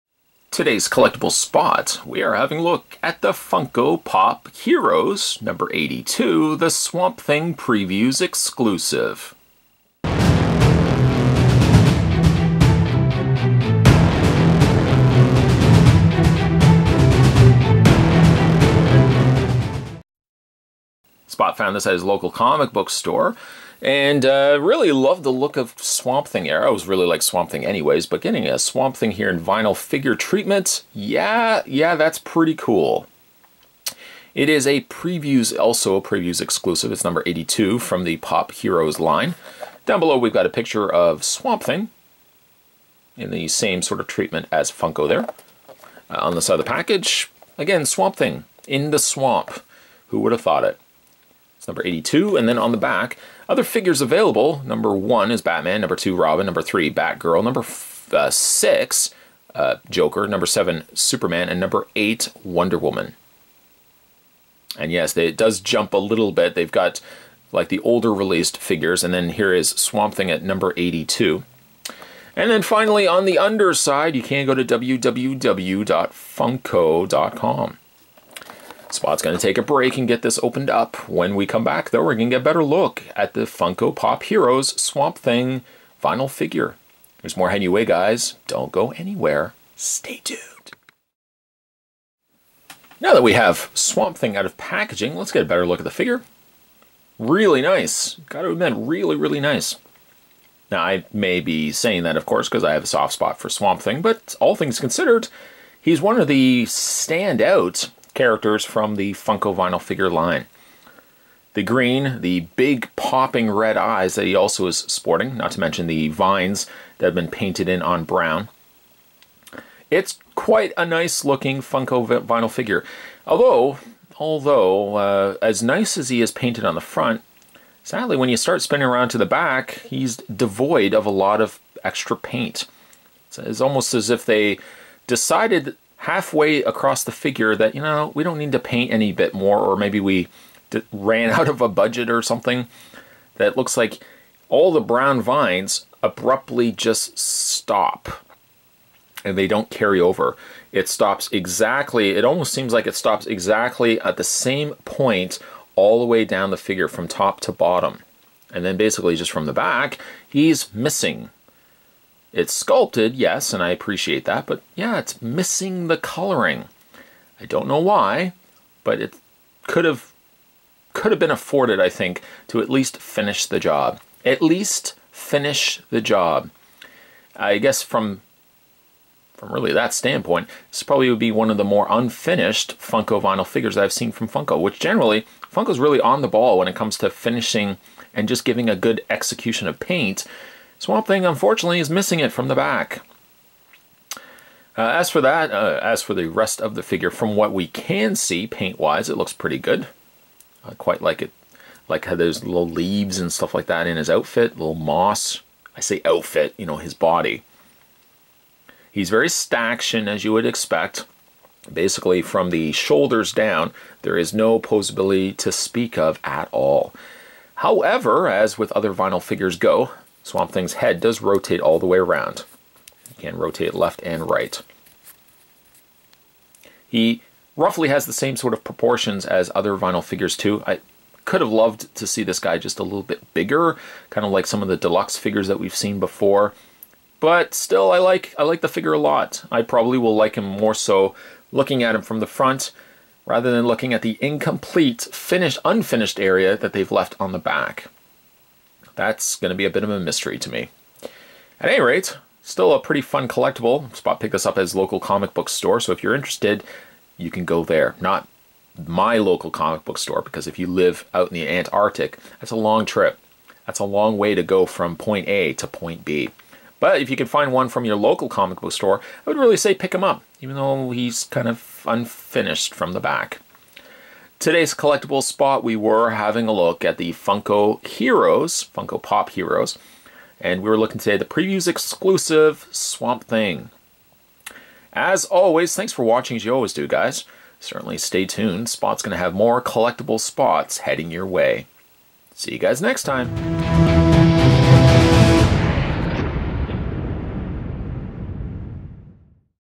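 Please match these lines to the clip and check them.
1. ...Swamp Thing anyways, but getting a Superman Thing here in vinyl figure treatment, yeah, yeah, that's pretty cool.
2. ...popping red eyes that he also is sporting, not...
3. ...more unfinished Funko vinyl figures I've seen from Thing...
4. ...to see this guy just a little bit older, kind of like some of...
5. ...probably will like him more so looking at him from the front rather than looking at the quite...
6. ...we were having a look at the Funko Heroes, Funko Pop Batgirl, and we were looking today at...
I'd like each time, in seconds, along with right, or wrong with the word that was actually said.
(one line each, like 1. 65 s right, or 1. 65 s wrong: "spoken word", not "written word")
1. 27 s wrong: "Swamp", not "Superman"
2. 112 s right
3. 181 s wrong: "Funko", not "Thing"
4. 231 s wrong: "bigger", not "older"
5. 239 s wrong: "incomplete", not "quite"
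6. 275 s wrong: "Heroes", not "Batgirl".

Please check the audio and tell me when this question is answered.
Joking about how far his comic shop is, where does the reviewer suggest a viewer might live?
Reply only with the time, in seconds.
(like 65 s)
261 s.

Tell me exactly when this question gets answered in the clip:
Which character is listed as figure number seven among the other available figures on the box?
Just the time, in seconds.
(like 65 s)
60 s.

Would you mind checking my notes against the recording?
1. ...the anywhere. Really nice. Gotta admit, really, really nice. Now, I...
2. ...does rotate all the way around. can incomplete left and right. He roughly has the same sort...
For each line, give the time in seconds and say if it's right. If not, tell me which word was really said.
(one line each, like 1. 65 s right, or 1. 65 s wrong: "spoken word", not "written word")
1. 95 s wrong: "figure", not "anywhere"
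2. 221 s wrong: "rotate", not "incomplete".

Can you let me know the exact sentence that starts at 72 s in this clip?
And then finally, on the underside, you can go to www.funko.com.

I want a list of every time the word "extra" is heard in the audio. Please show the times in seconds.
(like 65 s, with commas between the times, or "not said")
131 s.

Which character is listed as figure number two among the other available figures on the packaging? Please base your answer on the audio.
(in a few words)
Robin.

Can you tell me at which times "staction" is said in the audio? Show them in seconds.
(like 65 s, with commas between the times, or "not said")
209 s.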